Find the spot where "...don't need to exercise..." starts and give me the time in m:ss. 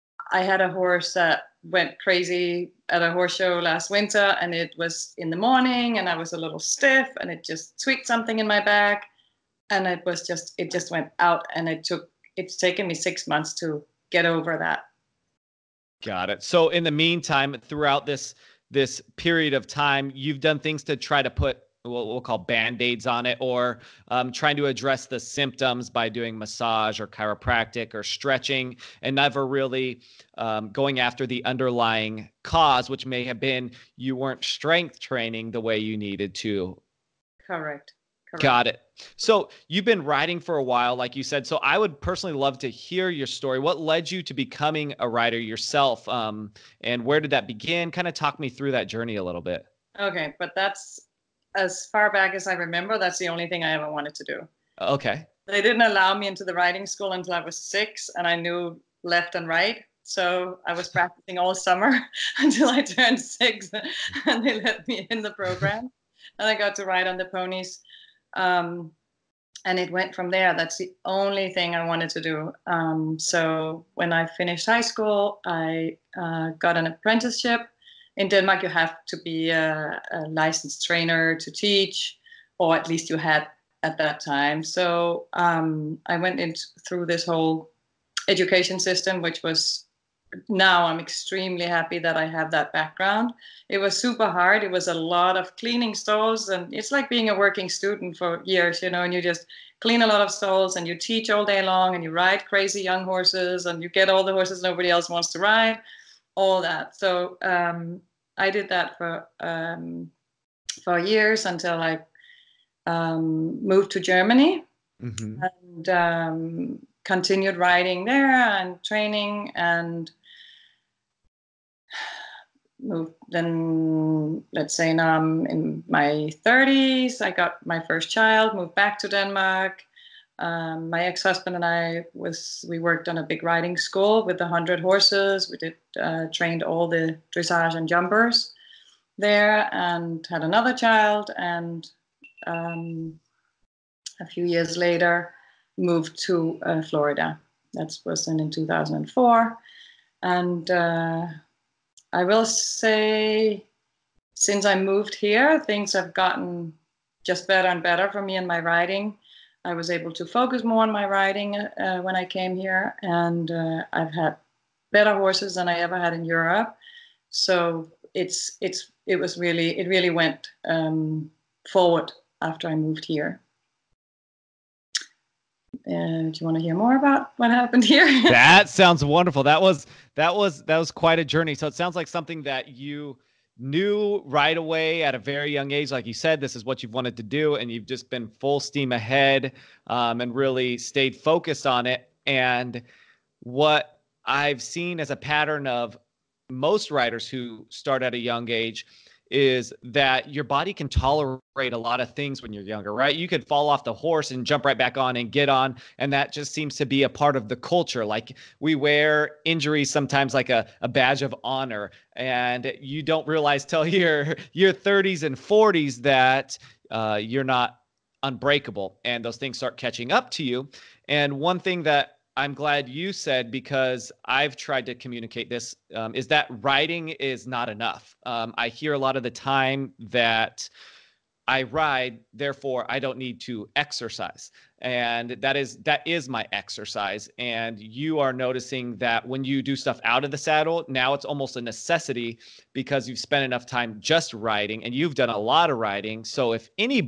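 3:52.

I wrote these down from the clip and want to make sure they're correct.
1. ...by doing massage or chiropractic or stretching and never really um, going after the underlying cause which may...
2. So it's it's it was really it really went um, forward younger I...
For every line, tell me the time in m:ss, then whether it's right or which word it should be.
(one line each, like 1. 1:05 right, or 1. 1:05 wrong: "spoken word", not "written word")
1. 0:25 right
2. 2:47 wrong: "after", not "younger".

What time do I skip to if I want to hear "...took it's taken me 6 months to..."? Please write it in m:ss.
0:11.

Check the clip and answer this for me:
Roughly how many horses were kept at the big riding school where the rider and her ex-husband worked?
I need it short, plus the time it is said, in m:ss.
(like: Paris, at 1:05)
100, at 2:14.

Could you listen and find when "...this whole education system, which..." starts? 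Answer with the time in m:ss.
1:27.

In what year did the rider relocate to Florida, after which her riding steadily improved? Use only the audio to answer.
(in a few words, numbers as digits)
2004.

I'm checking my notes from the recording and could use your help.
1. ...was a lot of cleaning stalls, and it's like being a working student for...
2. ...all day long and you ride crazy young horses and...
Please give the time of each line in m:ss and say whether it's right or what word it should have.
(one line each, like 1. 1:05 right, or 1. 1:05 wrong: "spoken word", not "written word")
1. 1:34 right
2. 1:41 right.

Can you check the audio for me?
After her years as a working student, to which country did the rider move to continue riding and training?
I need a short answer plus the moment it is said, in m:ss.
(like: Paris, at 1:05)
Germany, at 1:53.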